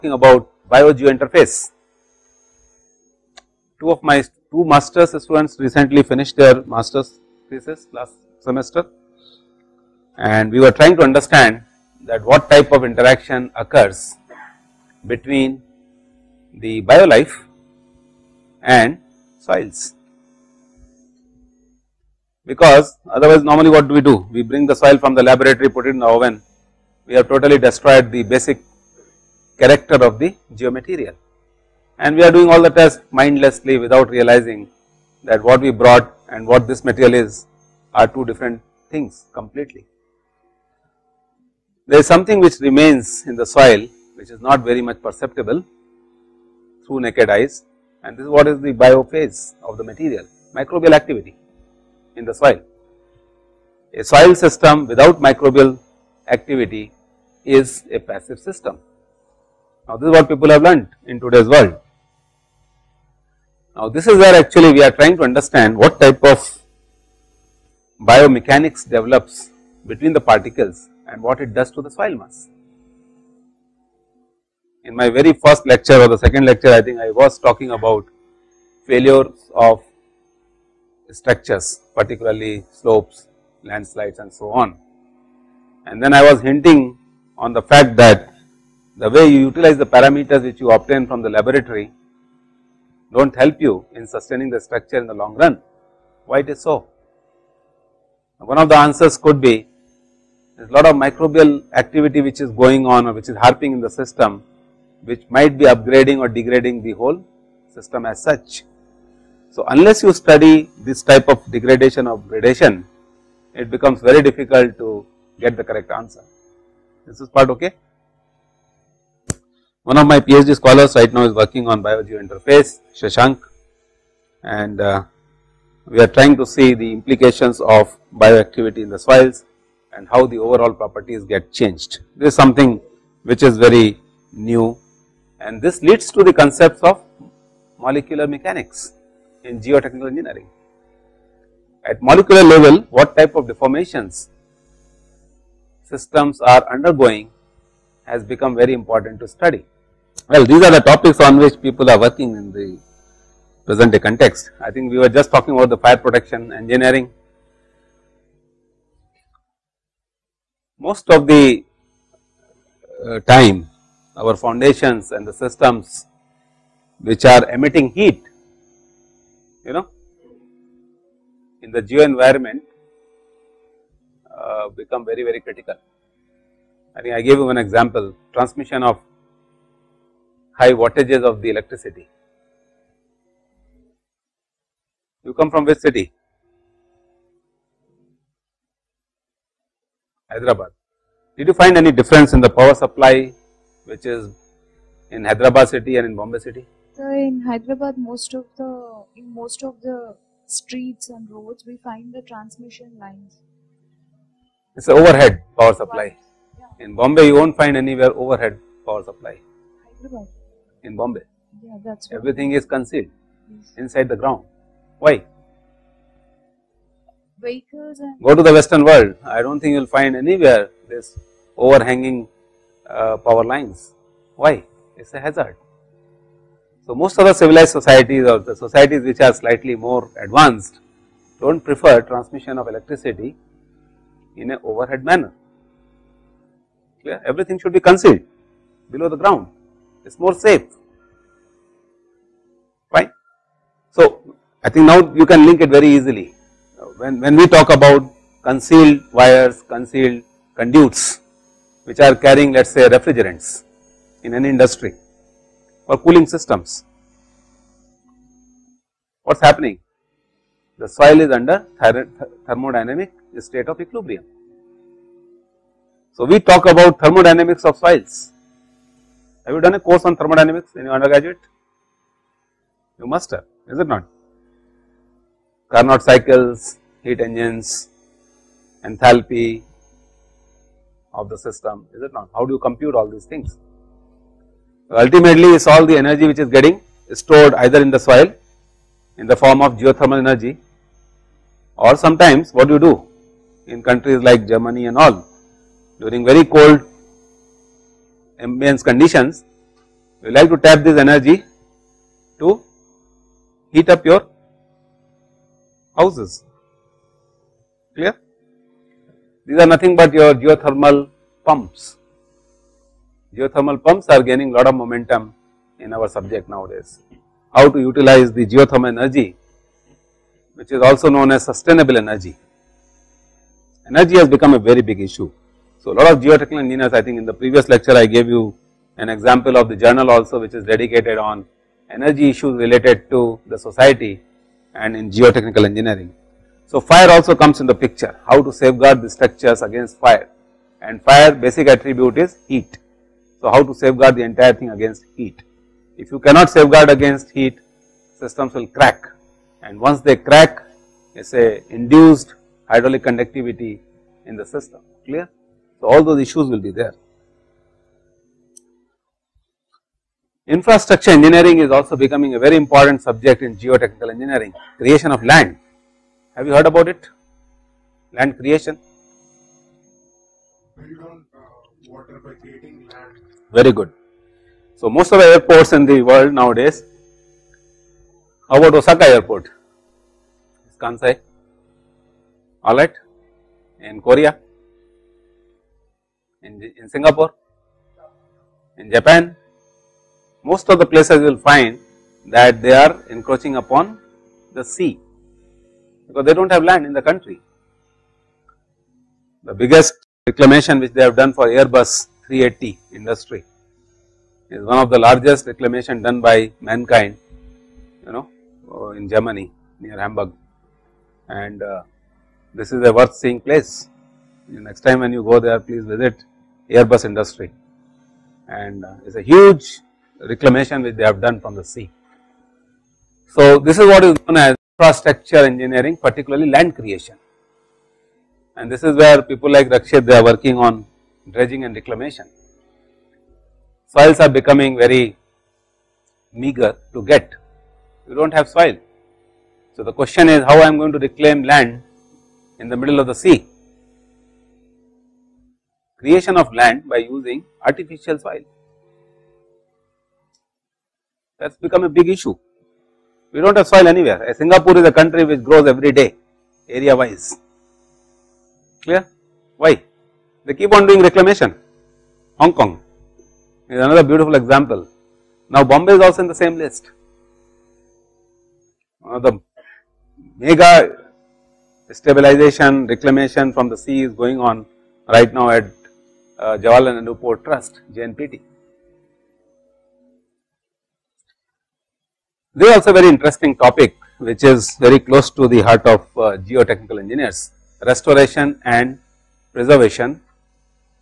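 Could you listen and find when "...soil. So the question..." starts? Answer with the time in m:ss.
7:18.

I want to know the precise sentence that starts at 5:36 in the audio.
So, fire also comes in the picture how to safeguard the structures against fire and fire basic attribute is heat.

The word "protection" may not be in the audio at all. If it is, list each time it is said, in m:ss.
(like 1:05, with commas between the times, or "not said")
2:35.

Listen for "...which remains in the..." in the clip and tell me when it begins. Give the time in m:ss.
0:42.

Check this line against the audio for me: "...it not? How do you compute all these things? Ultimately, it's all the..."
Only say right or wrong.
right.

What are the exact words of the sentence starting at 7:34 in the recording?
Singapore is a country which grows every day area wise.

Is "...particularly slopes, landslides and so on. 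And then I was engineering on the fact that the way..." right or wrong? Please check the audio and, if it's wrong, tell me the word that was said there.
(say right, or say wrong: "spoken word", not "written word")
wrong: "hinting", not "engineering".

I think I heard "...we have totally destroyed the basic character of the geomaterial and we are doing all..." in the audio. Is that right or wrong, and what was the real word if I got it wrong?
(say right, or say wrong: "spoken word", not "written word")
right.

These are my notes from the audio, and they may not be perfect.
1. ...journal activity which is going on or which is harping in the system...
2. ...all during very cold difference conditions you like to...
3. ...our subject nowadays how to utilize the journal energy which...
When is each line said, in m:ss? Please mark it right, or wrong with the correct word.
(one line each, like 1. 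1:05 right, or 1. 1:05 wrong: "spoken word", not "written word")
1. 1:40 wrong: "microbial", not "journal"
2. 4:54 wrong: "ambience", not "difference"
3. 5:15 wrong: "geothermal", not "journal".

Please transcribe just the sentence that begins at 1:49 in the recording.
So, unless you study this type of degradation or gradation, it becomes very difficult to get the correct answer.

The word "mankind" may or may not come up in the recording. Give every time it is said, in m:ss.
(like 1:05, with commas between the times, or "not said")
6:46.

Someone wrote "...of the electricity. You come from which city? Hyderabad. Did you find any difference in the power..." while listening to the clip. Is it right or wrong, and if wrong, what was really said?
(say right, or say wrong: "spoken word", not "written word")
right.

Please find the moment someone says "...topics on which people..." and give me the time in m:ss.
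2:30.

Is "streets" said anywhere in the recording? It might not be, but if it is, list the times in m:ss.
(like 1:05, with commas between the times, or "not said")
3:20.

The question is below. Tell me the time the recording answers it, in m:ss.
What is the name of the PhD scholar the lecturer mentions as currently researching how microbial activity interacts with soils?
2:02.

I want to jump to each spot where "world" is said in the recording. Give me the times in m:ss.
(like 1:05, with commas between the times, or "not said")
1:01, 3:38, 6:16.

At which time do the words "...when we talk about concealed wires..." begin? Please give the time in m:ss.
4:07.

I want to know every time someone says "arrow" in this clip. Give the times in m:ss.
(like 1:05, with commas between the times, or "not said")
not said.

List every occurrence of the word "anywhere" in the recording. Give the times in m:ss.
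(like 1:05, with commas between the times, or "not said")
3:27, 3:40, 7:33.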